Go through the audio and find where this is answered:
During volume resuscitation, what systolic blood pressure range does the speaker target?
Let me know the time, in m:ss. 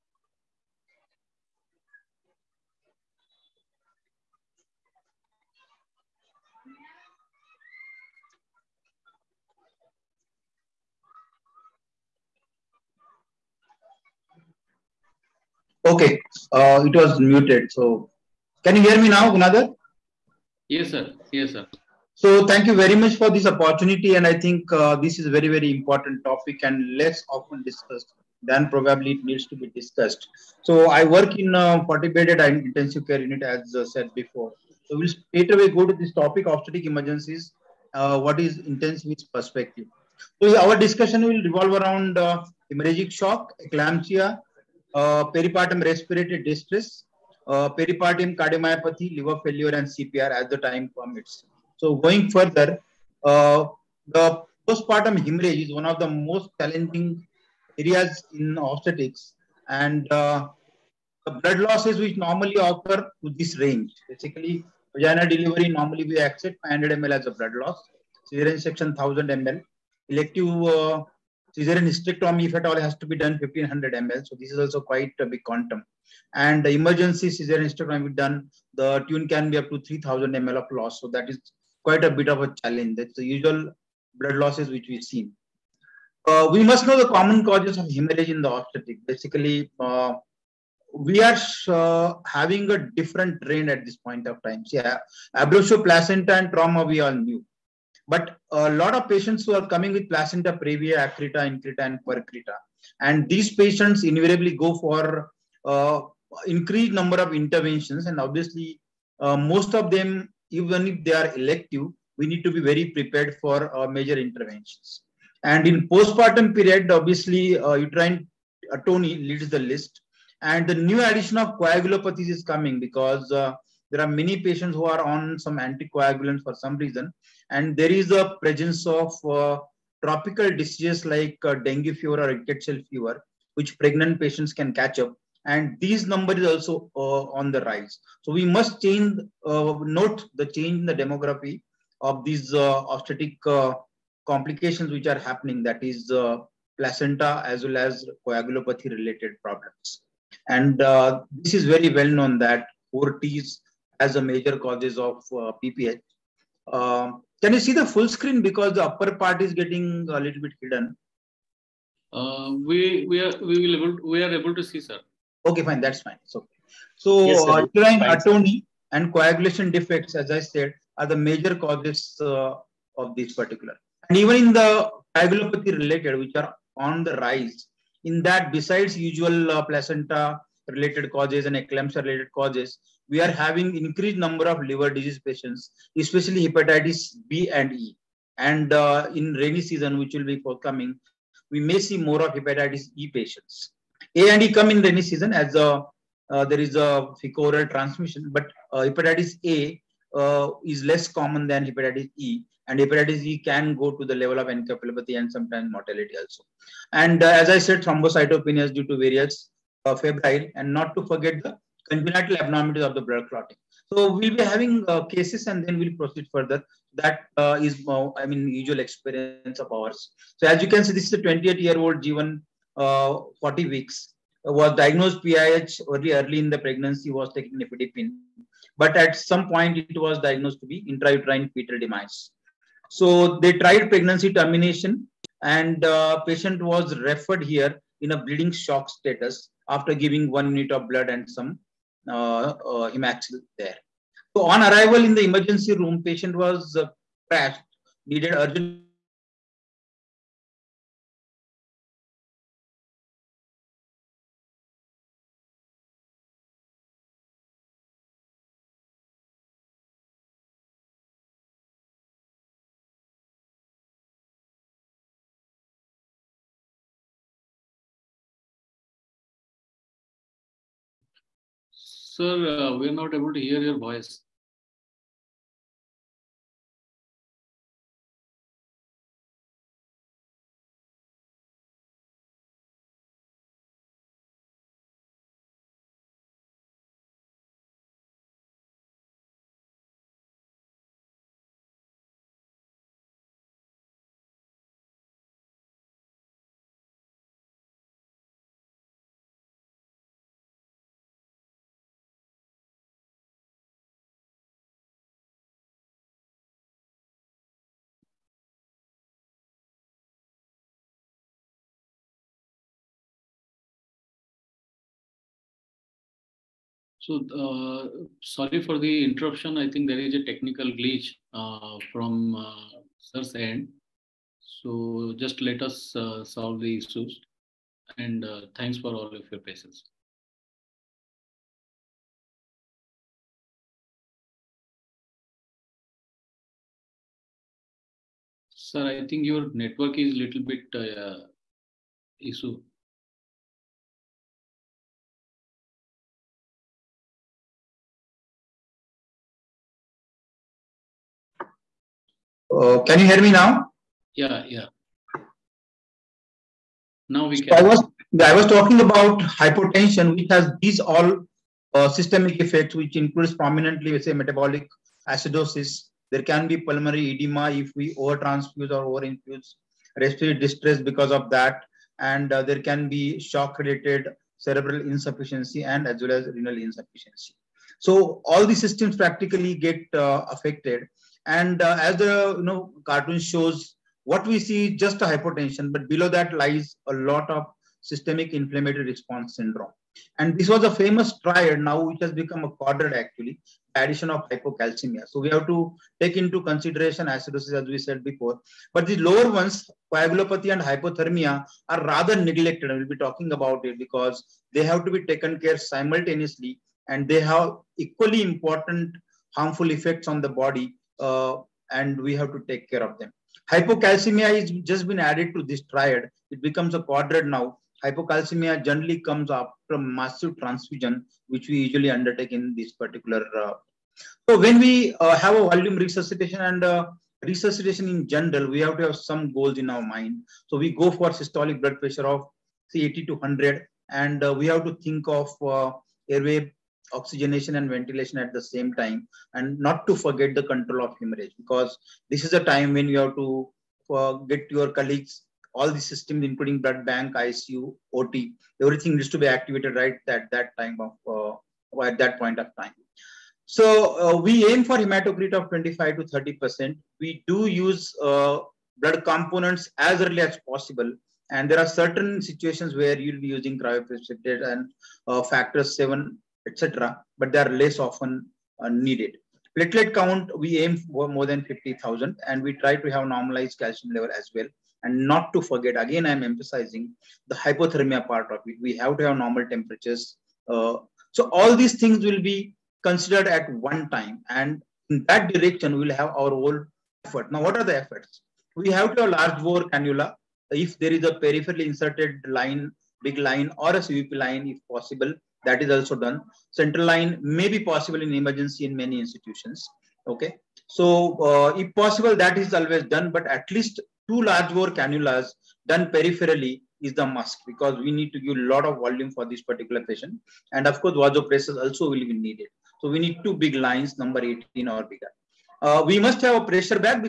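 7:12.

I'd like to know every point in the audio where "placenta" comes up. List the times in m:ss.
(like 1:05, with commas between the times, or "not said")
1:35, 1:40, 2:26, 2:59.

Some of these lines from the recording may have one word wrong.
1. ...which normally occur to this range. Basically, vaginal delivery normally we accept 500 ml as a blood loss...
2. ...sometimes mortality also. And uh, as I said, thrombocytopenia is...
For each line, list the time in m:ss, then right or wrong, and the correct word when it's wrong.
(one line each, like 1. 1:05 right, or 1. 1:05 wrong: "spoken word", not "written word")
1. 1:01 right
2. 3:25 right.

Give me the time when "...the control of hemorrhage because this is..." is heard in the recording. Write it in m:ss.
7:20.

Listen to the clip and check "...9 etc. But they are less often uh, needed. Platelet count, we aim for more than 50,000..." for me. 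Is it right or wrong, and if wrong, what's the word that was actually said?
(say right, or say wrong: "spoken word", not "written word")
wrong: "7", not "9".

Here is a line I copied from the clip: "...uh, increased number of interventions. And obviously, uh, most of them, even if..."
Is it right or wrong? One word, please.
right.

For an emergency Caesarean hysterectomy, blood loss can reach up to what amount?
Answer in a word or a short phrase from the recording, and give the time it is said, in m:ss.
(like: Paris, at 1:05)
3000 ml, at 1:19.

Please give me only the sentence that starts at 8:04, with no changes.
And in that direction, we'll have our whole effort.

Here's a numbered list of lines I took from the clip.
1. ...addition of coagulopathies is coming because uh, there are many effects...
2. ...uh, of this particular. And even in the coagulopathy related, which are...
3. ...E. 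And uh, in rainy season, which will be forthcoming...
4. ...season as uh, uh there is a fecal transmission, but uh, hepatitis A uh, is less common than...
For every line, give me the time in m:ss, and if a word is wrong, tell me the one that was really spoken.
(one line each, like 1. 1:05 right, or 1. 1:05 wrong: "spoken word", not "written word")
1. 2:01 wrong: "patients", not "effects"
2. 2:52 right
3. 3:07 right
4. 3:15 right.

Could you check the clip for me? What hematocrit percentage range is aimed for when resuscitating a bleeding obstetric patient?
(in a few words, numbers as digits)
25 to 30 percent.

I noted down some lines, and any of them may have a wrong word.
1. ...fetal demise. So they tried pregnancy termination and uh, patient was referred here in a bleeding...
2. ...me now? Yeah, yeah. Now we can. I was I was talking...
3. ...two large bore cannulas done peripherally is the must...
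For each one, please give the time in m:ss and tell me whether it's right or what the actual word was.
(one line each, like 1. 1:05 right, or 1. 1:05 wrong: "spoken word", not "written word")
1. 3:51 right
2. 5:53 right
3. 8:24 right.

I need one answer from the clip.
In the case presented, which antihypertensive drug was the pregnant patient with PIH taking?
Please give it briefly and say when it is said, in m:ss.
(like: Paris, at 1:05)
Nifedipine, at 3:47.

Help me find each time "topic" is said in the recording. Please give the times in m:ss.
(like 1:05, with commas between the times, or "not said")
0:26, 0:36.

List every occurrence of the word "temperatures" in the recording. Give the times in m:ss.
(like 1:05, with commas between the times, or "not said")
7:59.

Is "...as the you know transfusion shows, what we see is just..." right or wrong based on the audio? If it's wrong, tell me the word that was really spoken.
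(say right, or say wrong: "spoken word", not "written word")
wrong: "cartoon", not "transfusion".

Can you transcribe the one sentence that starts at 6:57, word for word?
Hypocalcemia generally comes after massive transfusion, which we usually undertake in this particular.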